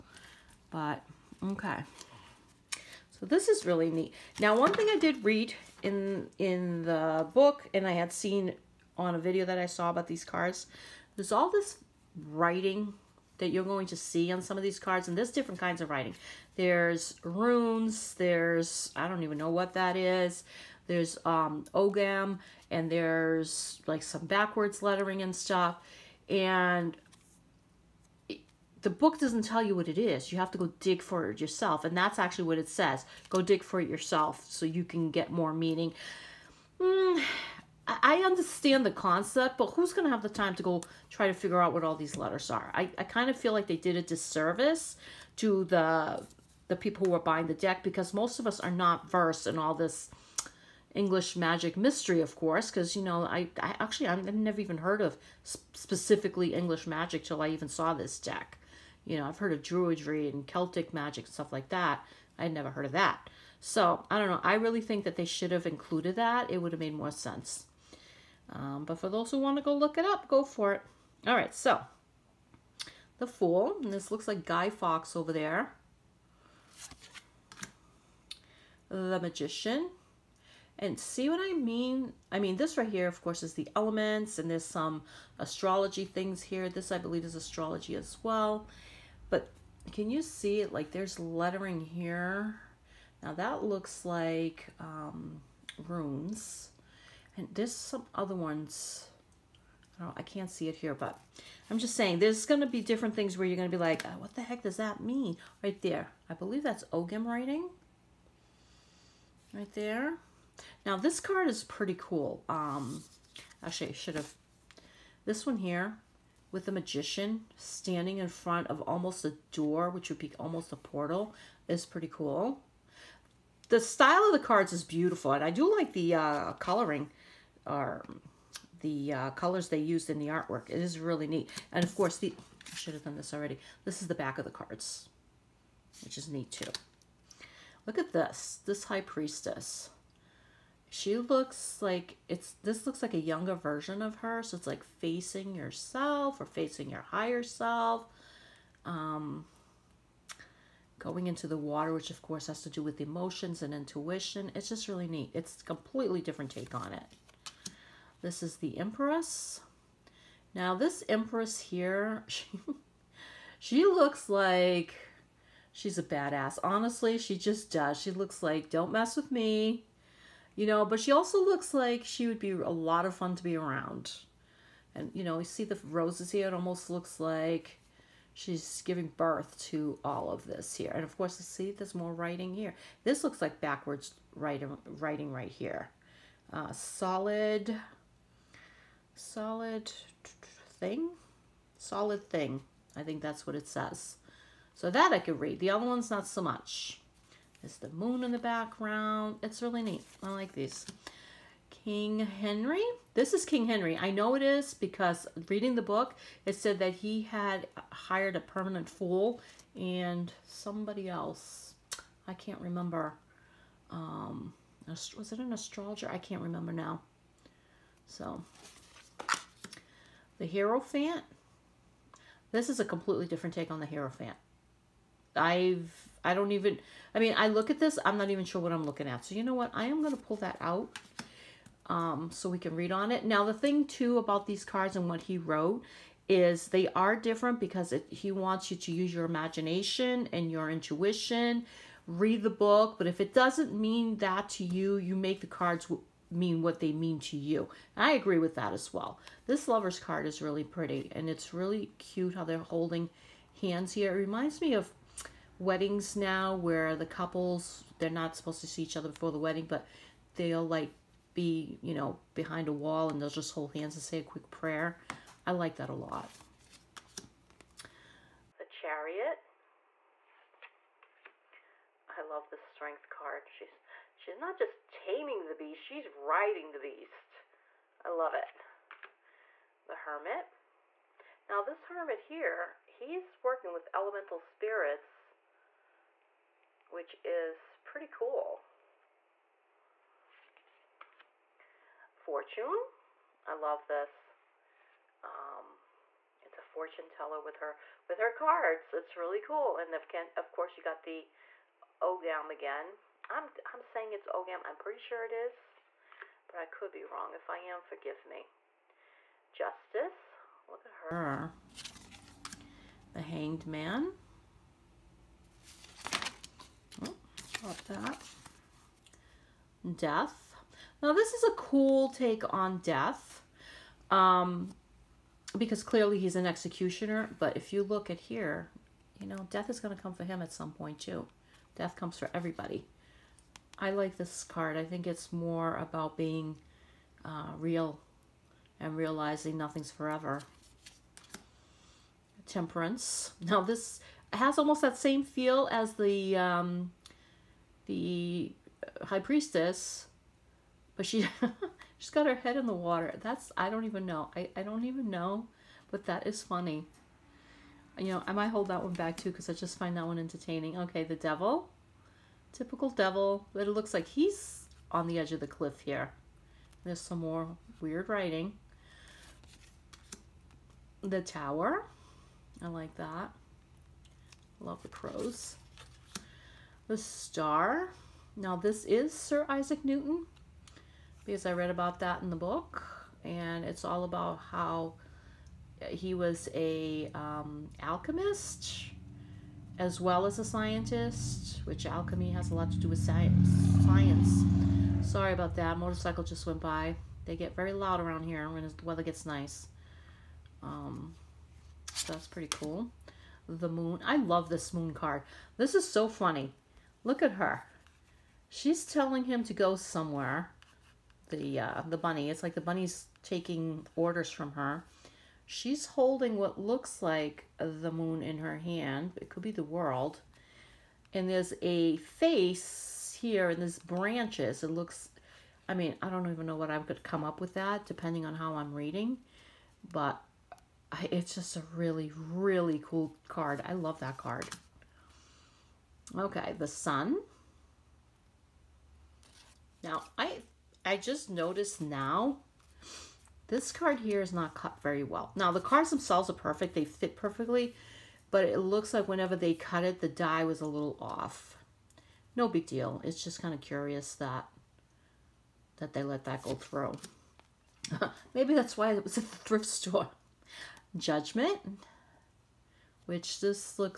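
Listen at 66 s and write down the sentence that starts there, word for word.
It would have made more sense.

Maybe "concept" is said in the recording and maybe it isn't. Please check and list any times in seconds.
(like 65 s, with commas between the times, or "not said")
38 s.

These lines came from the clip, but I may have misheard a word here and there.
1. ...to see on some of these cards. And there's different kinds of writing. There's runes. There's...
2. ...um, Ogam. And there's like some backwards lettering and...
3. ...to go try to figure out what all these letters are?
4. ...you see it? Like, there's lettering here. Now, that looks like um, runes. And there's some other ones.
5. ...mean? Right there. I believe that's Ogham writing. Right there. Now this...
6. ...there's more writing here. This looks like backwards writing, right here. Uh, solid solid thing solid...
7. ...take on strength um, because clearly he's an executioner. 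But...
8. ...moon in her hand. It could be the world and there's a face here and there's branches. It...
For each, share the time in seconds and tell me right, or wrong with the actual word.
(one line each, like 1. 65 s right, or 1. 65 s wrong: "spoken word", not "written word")
1. 13 s right
2. 21 s right
3. 40 s right
4. 90 s right
5. 104 s right
6. 181 s right
7. 322 s wrong: "death", not "strength"
8. 417 s right.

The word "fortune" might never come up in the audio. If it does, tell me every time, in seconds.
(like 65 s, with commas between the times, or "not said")
292 s, 296 s.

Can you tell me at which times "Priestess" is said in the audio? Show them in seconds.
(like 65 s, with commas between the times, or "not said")
139 s, 349 s.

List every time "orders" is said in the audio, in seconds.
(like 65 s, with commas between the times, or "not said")
413 s.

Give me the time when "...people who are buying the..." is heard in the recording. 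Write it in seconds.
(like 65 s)
46 s.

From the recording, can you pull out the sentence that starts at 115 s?
This one here with the magician standing in front of almost a door, which would be almost a portal, is pretty cool.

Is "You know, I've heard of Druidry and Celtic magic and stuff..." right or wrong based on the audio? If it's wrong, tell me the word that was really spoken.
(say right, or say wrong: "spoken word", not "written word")
right.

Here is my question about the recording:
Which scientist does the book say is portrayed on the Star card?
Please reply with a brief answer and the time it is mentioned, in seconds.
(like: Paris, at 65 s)
Sir Isaac Newton, at 379 s.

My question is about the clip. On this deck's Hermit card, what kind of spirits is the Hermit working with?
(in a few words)
elemental spirits.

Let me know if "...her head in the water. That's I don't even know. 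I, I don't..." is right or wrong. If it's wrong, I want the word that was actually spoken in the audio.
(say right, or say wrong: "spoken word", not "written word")
right.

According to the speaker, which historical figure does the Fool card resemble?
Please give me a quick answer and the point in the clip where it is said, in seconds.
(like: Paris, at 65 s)
Guy Fawkes, at 74 s.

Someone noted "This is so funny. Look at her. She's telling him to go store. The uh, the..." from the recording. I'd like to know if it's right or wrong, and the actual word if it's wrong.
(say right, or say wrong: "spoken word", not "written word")
wrong: "somewhere", not "store".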